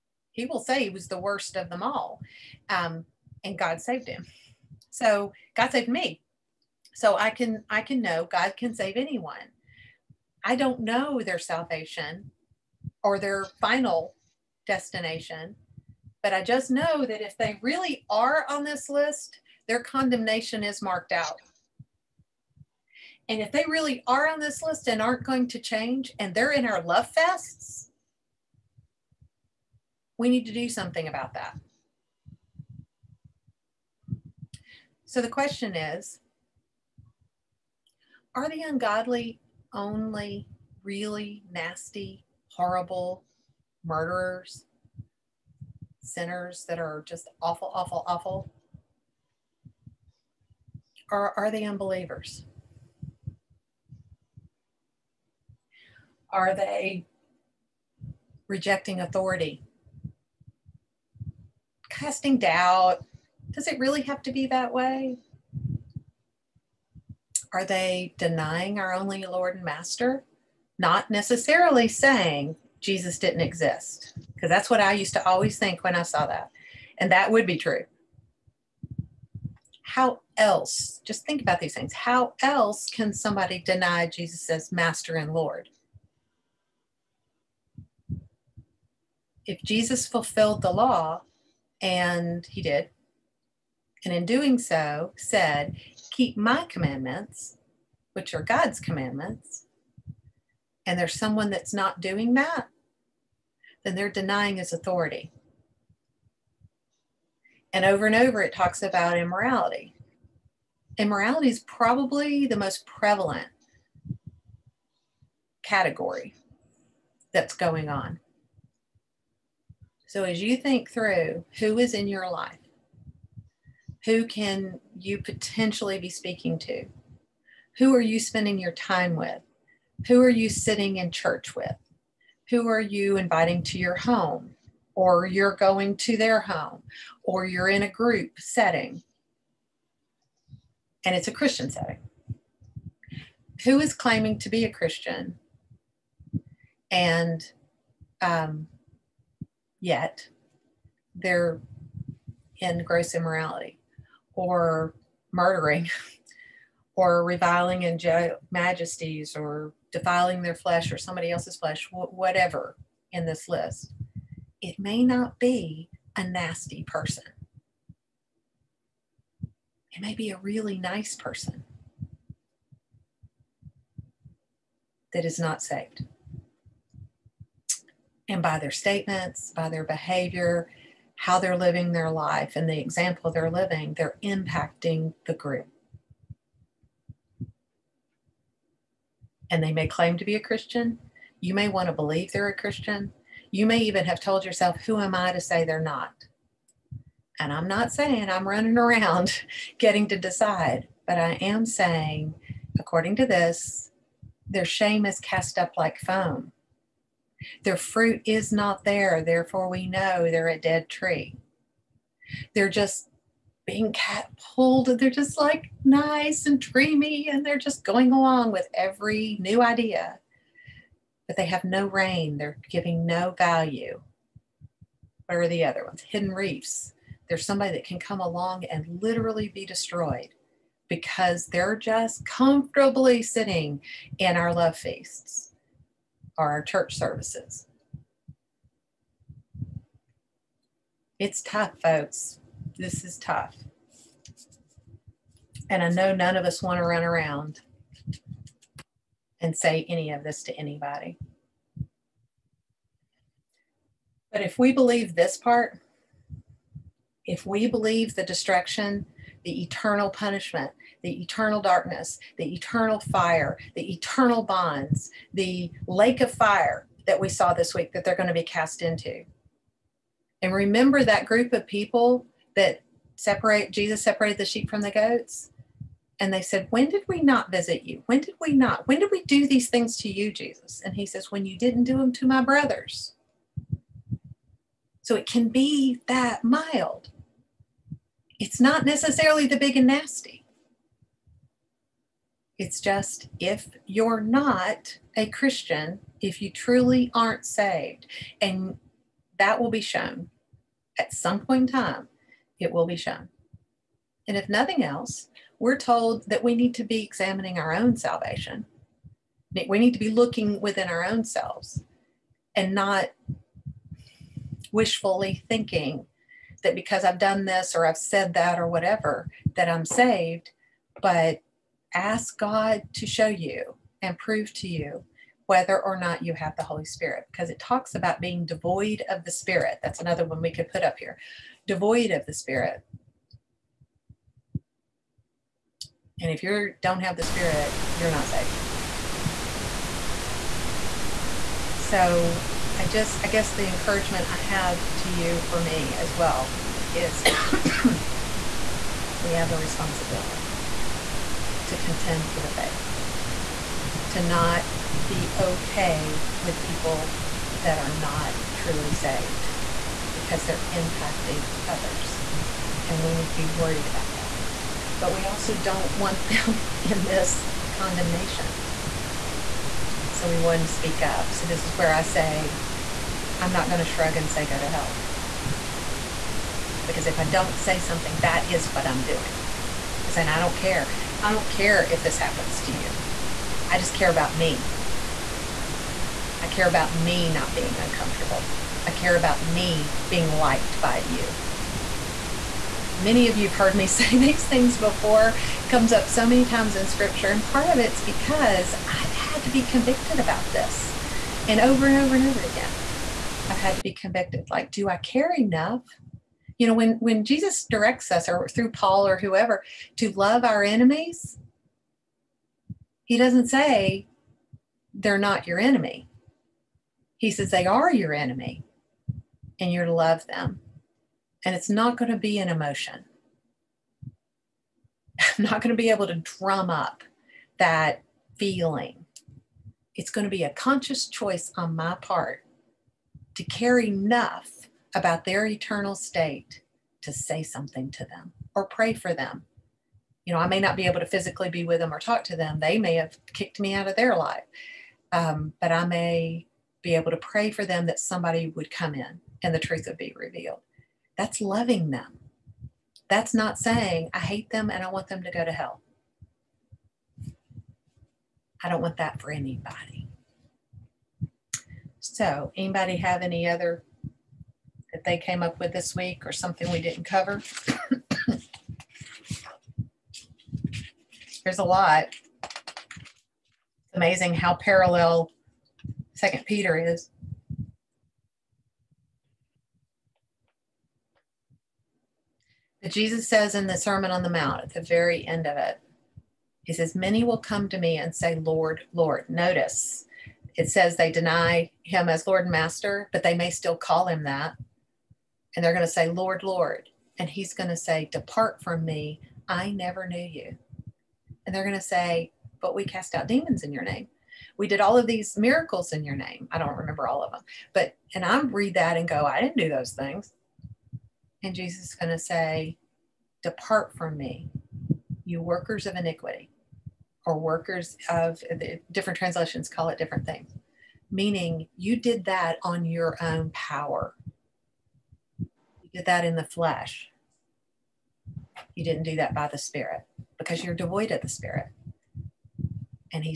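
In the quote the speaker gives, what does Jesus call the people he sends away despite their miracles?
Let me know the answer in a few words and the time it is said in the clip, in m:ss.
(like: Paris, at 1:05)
Workers of iniquity, at 8:35.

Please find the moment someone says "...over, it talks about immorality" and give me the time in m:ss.
1:48.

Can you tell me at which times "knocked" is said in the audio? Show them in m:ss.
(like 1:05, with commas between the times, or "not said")
not said.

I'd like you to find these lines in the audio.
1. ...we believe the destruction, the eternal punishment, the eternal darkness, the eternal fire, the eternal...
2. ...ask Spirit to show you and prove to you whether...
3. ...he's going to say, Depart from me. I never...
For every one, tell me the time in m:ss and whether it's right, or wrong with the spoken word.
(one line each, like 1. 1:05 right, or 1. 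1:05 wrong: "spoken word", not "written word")
1. 4:17 right
2. 5:21 wrong: "God", not "Spirit"
3. 8:17 right.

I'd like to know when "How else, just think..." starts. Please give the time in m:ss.
1:19.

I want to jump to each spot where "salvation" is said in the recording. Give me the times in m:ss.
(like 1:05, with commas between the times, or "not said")
0:11, 5:07.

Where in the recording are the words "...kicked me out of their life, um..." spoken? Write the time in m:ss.
7:23.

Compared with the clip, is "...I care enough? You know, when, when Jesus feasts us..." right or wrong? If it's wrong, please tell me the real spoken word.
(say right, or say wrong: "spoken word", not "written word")
wrong: "directs", not "feasts".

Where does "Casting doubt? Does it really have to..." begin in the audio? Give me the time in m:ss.
1:01.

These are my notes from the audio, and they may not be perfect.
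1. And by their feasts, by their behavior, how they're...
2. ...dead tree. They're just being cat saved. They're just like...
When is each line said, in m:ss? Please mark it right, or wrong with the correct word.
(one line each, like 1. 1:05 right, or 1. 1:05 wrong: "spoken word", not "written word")
1. 2:58 wrong: "statements", not "feasts"
2. 3:30 wrong: "pulled", not "saved".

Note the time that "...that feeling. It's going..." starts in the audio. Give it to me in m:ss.
7:07.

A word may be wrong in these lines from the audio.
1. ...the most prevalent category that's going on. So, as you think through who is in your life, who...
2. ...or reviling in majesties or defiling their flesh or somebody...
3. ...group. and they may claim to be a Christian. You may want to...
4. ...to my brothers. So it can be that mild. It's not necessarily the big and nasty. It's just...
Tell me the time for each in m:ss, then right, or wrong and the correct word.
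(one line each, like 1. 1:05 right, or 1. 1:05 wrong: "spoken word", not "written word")
1. 1:52 right
2. 2:36 right
3. 3:05 right
4. 4:42 right.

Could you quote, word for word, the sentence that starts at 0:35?
So the question is Are the ungodly only really nasty, horrible murderers?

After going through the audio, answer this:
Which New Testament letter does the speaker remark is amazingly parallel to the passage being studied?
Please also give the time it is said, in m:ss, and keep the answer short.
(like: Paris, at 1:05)
Second Peter, at 7:56.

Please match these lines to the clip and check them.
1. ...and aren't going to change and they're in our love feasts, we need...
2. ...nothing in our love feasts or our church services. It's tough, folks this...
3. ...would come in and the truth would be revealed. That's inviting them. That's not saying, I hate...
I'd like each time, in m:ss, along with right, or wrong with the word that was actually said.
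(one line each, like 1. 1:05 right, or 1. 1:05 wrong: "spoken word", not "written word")
1. 0:24 wrong: "fests", not "feasts"
2. 3:53 wrong: "sitting", not "nothing"
3. 7:28 wrong: "loving", not "inviting".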